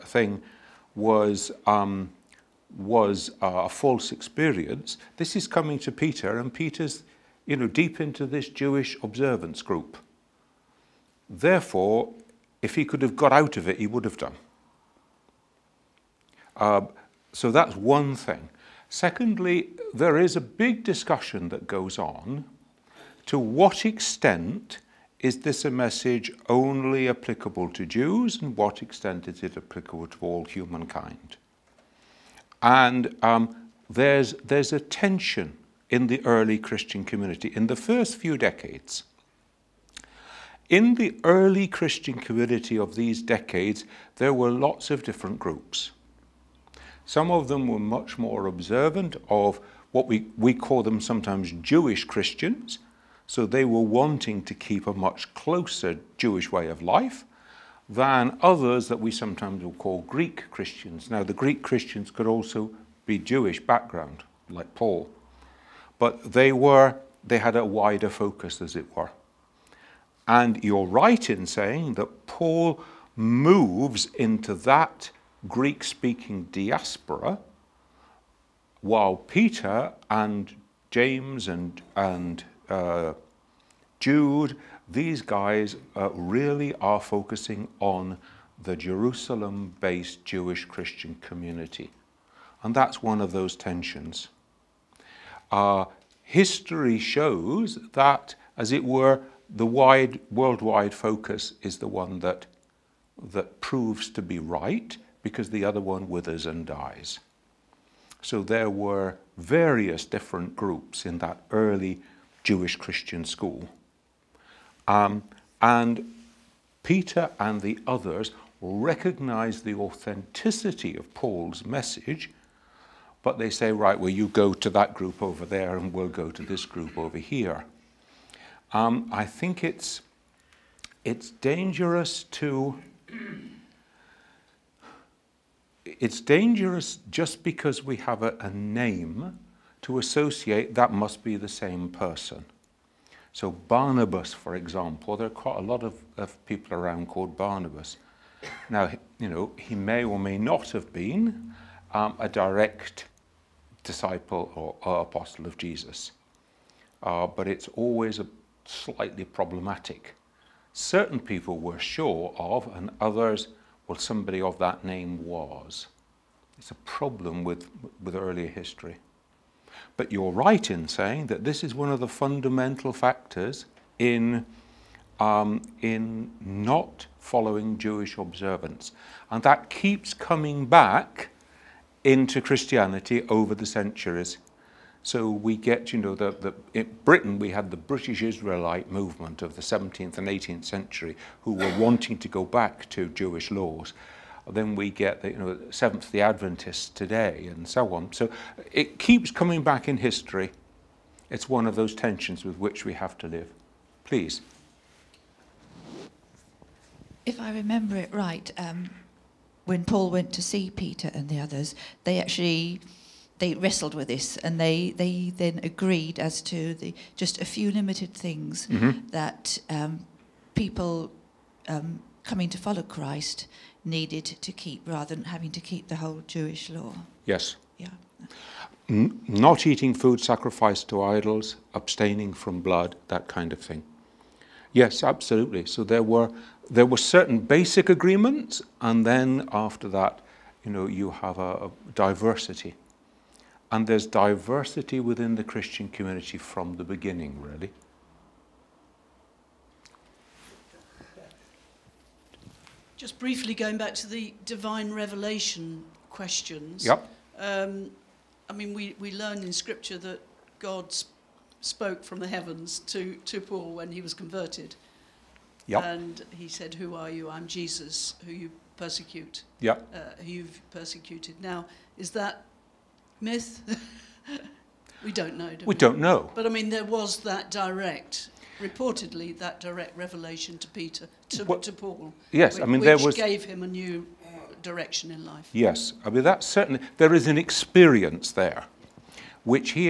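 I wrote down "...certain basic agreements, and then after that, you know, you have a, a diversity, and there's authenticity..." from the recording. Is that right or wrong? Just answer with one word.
wrong.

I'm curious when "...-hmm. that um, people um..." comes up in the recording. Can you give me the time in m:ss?
3:38.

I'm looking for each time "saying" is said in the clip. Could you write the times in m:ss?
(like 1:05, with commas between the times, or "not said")
1:11, 2:50.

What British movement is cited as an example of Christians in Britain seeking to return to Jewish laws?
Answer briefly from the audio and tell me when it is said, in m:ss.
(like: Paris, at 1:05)
British Israelite movement, at 3:07.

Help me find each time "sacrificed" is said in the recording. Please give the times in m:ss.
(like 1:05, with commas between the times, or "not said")
3:50.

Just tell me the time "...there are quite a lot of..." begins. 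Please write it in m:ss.
2:25.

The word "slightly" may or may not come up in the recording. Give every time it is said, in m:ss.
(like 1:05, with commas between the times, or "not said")
2:38.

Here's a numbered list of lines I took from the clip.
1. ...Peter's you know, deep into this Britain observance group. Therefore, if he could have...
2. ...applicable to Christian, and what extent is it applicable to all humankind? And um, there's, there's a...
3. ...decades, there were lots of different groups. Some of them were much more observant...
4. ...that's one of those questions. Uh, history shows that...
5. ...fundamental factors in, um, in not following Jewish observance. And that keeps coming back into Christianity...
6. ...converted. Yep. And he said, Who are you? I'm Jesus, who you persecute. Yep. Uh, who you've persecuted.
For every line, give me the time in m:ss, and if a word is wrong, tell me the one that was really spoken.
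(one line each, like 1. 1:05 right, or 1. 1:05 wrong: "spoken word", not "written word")
1. 0:06 wrong: "Jewish", not "Britain"
2. 0:27 wrong: "Jews", not "Christian"
3. 0:43 right
4. 1:32 wrong: "tensions", not "questions"
5. 2:52 right
6. 4:24 right.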